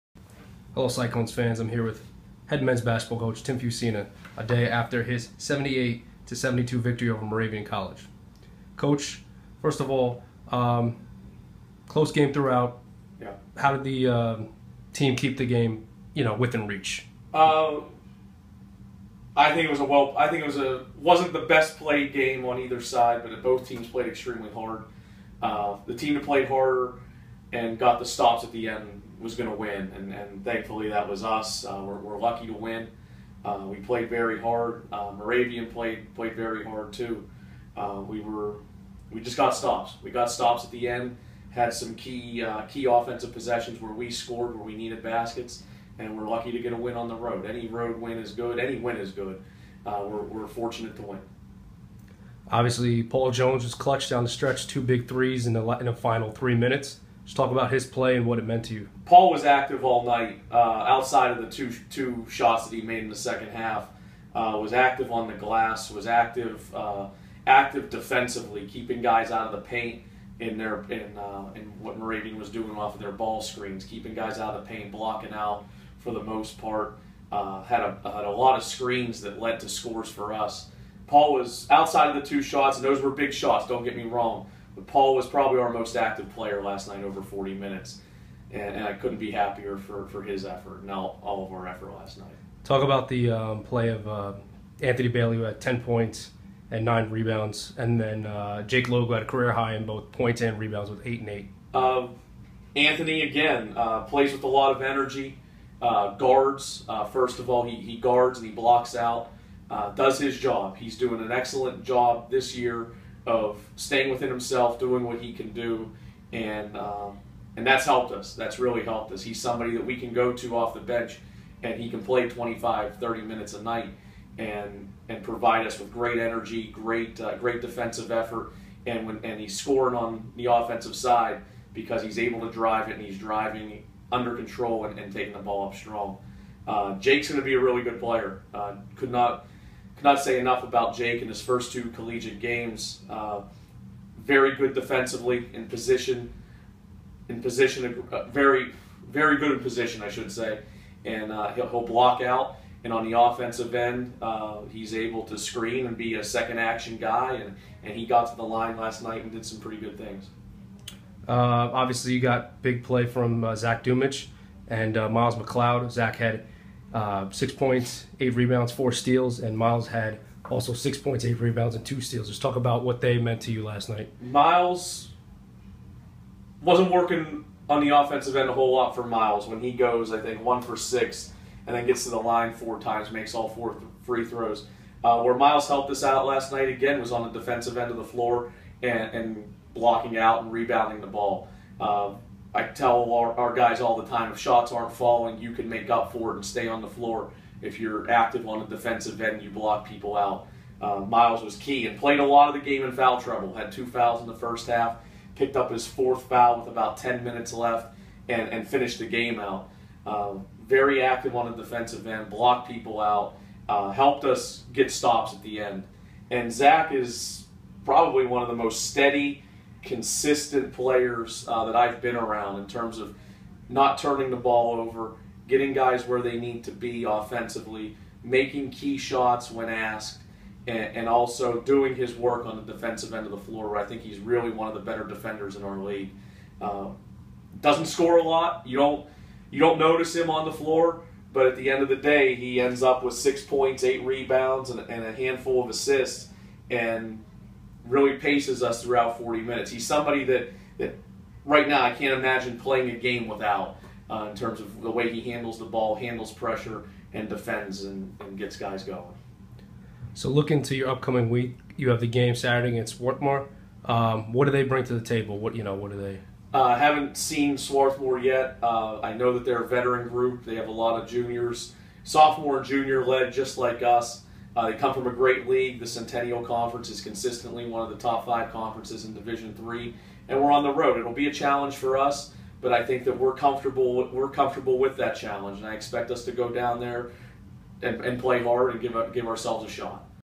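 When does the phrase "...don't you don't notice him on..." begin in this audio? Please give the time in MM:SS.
03:58.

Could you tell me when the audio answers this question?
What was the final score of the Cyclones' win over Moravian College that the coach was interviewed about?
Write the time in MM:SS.
00:05.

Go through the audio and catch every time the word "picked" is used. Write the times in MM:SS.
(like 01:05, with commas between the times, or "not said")
03:25.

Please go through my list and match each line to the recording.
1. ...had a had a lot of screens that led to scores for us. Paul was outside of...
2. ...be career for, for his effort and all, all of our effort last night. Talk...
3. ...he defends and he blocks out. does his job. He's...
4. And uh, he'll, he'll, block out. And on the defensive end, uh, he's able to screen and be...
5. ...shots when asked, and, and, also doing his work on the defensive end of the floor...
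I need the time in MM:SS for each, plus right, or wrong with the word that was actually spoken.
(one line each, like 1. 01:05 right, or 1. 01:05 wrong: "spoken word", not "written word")
1. 01:17 right
2. 01:29 wrong: "happier", not "career"
3. 01:47 wrong: "guards", not "defends"
4. 02:31 wrong: "offensive", not "defensive"
5. 03:48 right.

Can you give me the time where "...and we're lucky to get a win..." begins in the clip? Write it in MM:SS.
00:45.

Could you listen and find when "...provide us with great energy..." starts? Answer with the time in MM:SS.
02:05.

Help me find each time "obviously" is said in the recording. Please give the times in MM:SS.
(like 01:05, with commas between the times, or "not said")
00:52, 02:41.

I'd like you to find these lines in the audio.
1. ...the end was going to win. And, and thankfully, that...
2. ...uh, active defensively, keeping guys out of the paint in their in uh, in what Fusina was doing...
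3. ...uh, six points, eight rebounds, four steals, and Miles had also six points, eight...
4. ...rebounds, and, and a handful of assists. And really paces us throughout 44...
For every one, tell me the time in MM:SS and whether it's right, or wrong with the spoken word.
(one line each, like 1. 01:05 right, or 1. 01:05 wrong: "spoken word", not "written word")
1. 00:28 right
2. 01:06 wrong: "Moravian", not "Fusina"
3. 02:46 right
4. 04:04 wrong: "40", not "44".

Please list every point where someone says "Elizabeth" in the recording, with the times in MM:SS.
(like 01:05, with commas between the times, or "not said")
not said.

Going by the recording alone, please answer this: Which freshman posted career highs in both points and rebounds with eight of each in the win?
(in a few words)
Jake Logo.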